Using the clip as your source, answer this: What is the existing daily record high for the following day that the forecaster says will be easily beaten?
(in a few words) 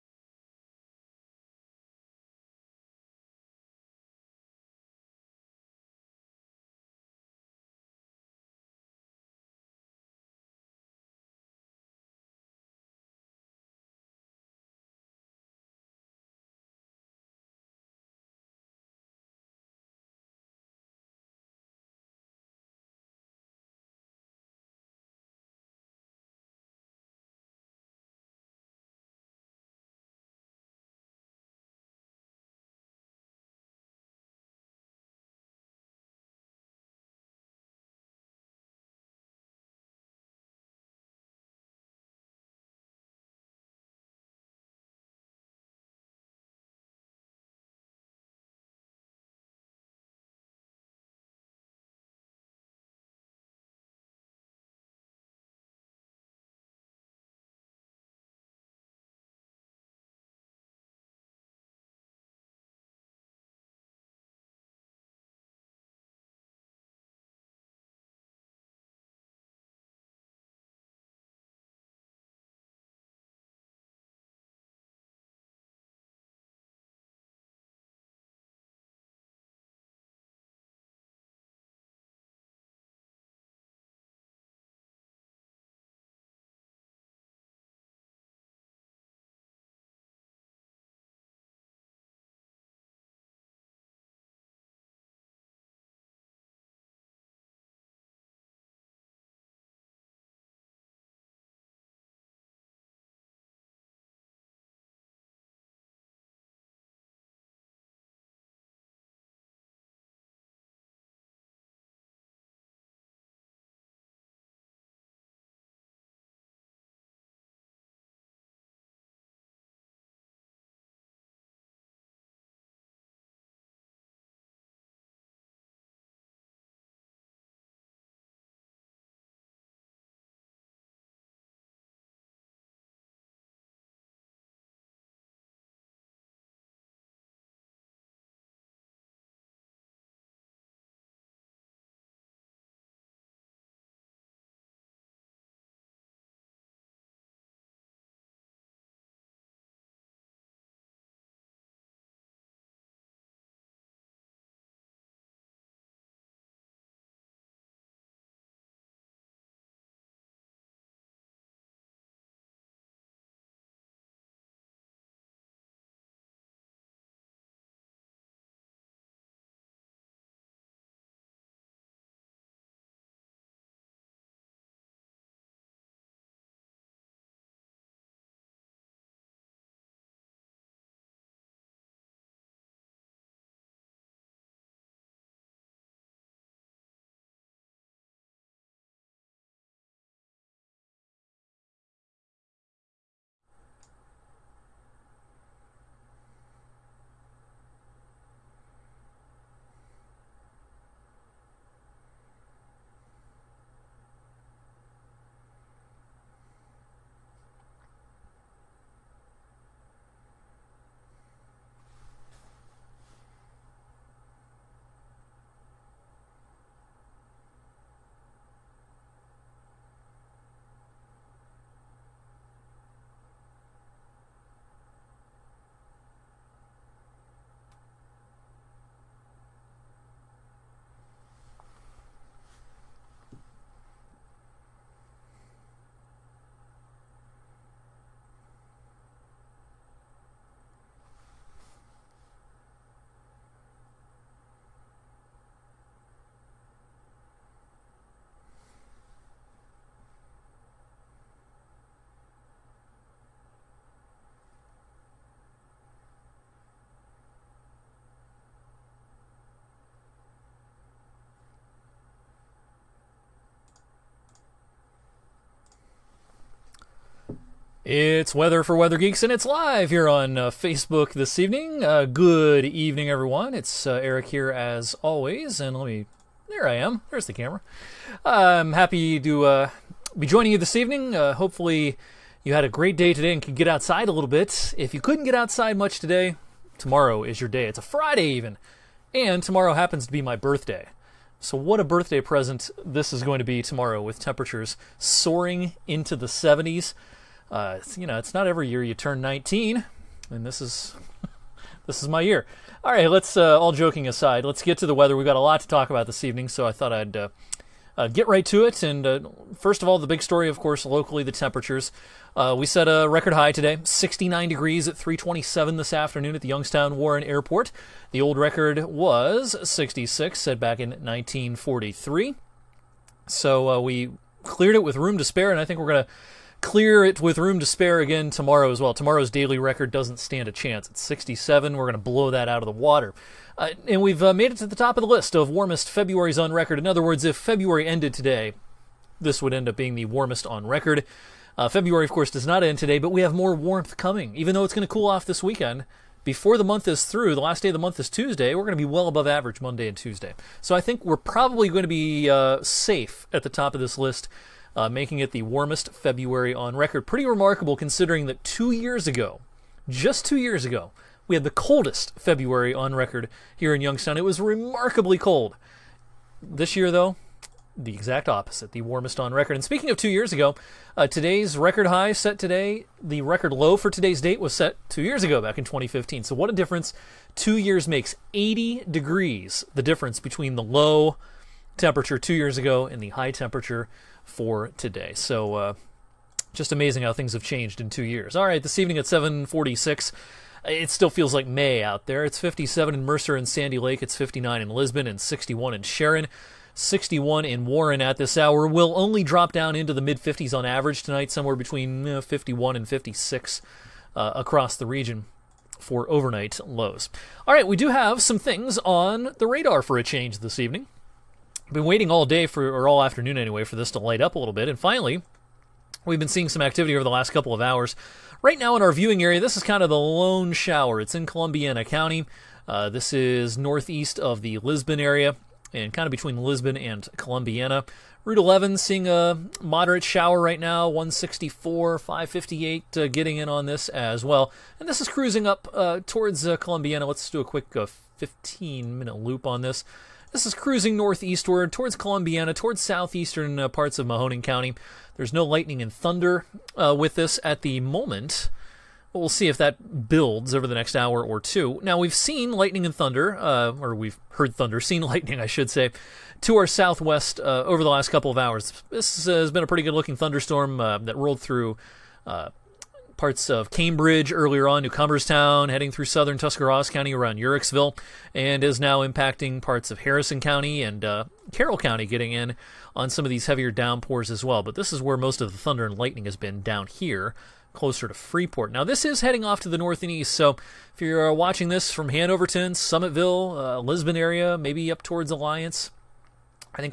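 67.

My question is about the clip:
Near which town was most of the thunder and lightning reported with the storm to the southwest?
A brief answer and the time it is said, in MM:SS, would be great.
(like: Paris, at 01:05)
Freeport, at 07:58.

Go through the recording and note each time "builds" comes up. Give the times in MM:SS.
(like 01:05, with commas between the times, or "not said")
07:30.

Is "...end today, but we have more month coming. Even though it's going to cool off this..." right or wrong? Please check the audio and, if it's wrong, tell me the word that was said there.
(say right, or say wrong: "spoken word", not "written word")
wrong: "warmth", not "month".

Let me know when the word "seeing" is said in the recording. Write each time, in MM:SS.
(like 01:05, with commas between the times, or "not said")
06:56, 07:08.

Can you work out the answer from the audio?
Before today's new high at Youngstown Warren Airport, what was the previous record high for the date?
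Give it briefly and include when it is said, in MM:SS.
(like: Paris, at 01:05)
66, at 05:18.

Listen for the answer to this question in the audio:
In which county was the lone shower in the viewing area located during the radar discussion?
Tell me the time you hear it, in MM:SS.
07:01.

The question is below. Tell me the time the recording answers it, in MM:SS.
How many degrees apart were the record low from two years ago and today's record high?
06:18.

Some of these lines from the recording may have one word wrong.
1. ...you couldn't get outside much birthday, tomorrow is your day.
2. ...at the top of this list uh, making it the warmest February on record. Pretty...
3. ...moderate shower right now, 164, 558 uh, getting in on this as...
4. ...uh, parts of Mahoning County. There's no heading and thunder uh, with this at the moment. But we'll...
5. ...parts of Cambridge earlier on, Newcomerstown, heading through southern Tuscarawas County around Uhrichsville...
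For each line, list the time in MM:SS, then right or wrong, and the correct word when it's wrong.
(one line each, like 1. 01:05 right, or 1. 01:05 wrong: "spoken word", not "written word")
1. 04:44 wrong: "today", not "birthday"
2. 05:53 right
3. 07:09 right
4. 07:23 wrong: "lightning", not "heading"
5. 07:43 right.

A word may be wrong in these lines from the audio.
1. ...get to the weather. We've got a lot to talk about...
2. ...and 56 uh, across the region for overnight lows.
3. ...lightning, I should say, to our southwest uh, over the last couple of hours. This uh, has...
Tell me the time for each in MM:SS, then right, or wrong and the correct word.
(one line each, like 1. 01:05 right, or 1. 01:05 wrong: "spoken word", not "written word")
1. 05:04 right
2. 06:42 right
3. 07:35 right.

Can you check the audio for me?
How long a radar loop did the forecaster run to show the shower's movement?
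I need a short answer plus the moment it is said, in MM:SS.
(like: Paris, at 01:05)
15 minutes, at 07:18.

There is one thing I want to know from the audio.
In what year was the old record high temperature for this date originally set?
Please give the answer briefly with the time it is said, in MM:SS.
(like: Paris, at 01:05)
1943, at 05:20.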